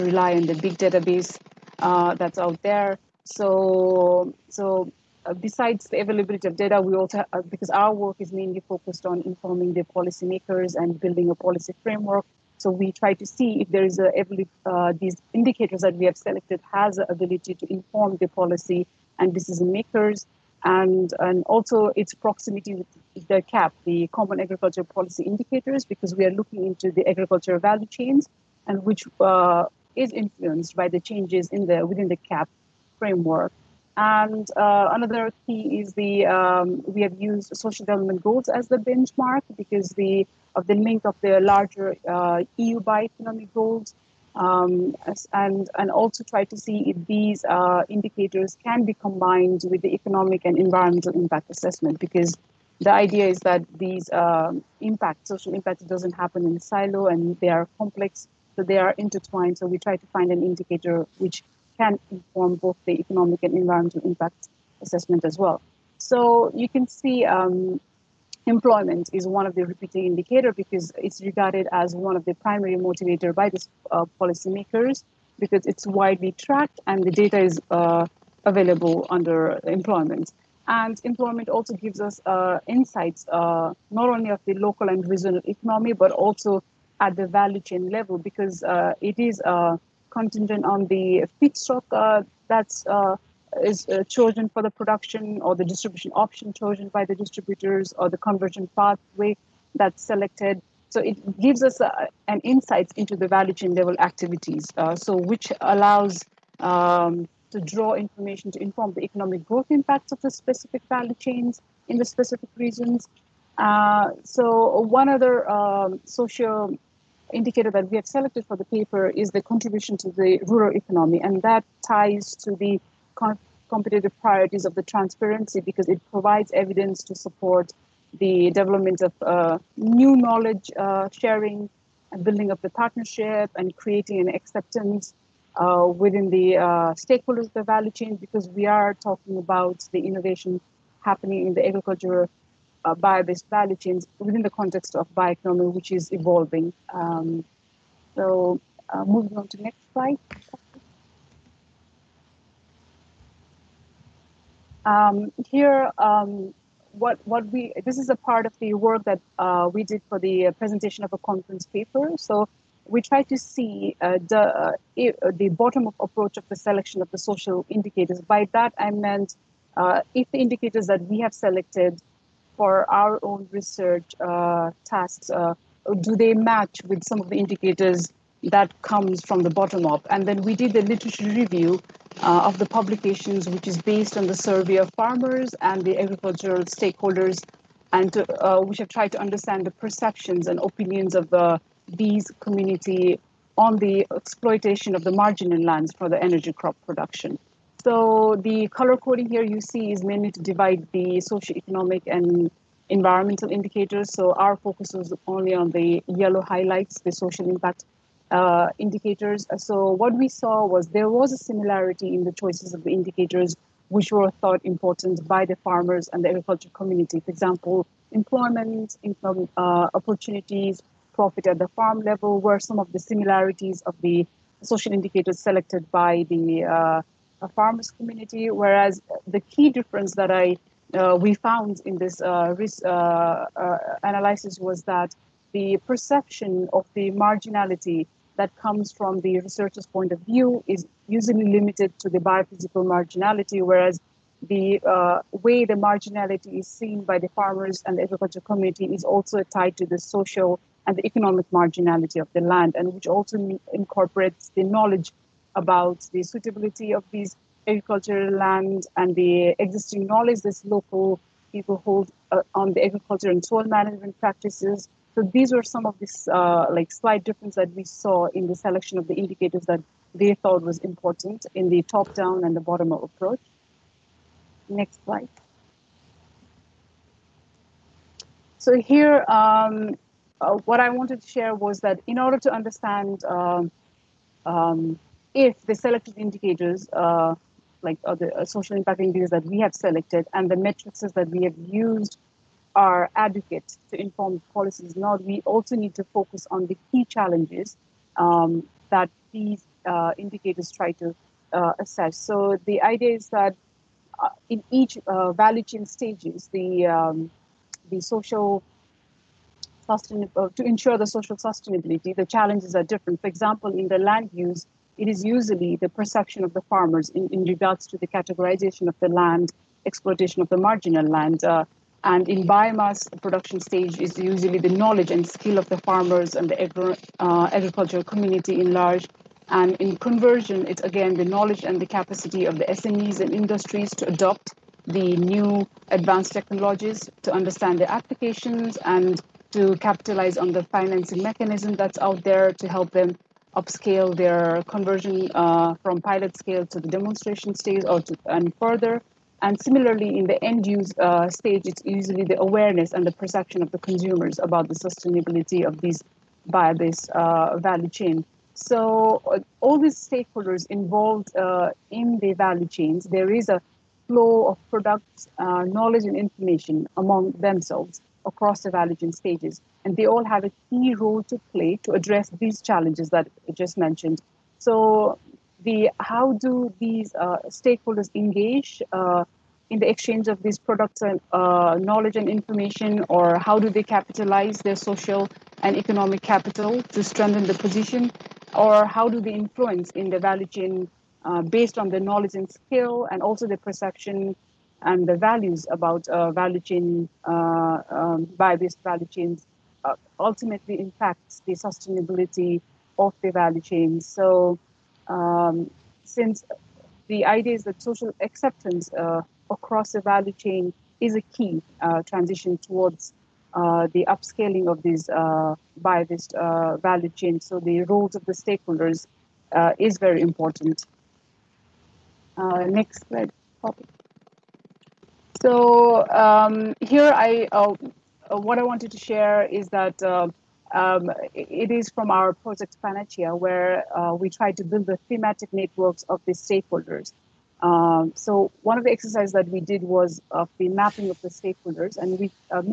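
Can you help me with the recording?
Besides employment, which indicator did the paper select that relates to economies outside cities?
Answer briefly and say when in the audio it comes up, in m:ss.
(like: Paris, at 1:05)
contribution to the rural economy, at 1:59.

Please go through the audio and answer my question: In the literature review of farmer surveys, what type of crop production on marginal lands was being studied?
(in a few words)
energy crop production.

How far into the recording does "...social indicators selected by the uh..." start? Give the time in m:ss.
3:44.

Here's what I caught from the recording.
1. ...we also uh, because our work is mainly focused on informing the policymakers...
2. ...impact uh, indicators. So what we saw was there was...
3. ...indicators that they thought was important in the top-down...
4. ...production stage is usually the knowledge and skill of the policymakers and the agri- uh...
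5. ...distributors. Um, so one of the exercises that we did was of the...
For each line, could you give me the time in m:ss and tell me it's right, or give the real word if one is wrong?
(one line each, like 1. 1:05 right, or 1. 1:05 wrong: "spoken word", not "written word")
1. 0:06 right
2. 3:27 right
3. 4:29 right
4. 5:23 wrong: "farmers", not "policymakers"
5. 7:16 wrong: "stakeholders", not "distributors".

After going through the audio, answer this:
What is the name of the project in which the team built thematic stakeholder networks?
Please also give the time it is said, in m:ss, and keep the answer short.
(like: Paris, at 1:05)
Panacea, at 7:12.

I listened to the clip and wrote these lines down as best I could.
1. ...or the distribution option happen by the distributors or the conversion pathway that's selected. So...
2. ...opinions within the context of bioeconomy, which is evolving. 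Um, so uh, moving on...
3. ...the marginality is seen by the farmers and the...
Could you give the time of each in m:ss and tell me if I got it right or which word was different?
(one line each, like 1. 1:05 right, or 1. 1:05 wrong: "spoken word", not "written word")
1. 1:35 wrong: "chosen", not "happen"
2. 2:23 wrong: "chains", not "opinions"
3. 4:05 right.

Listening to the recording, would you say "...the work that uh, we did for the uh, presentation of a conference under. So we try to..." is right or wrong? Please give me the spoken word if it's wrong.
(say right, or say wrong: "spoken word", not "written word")
wrong: "paper", not "under".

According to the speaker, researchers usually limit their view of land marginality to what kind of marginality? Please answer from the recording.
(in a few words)
biophysical marginality.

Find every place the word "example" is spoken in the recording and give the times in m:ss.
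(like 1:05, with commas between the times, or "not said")
3:37, 5:13.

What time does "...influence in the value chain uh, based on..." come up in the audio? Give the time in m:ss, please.
6:29.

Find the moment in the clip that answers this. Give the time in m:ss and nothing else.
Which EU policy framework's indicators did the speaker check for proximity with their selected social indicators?
0:24.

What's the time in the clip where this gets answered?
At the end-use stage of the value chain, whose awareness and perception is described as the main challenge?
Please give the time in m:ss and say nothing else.
5:53.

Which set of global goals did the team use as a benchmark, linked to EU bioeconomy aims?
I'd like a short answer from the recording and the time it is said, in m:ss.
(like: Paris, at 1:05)
social development goals, at 0:37.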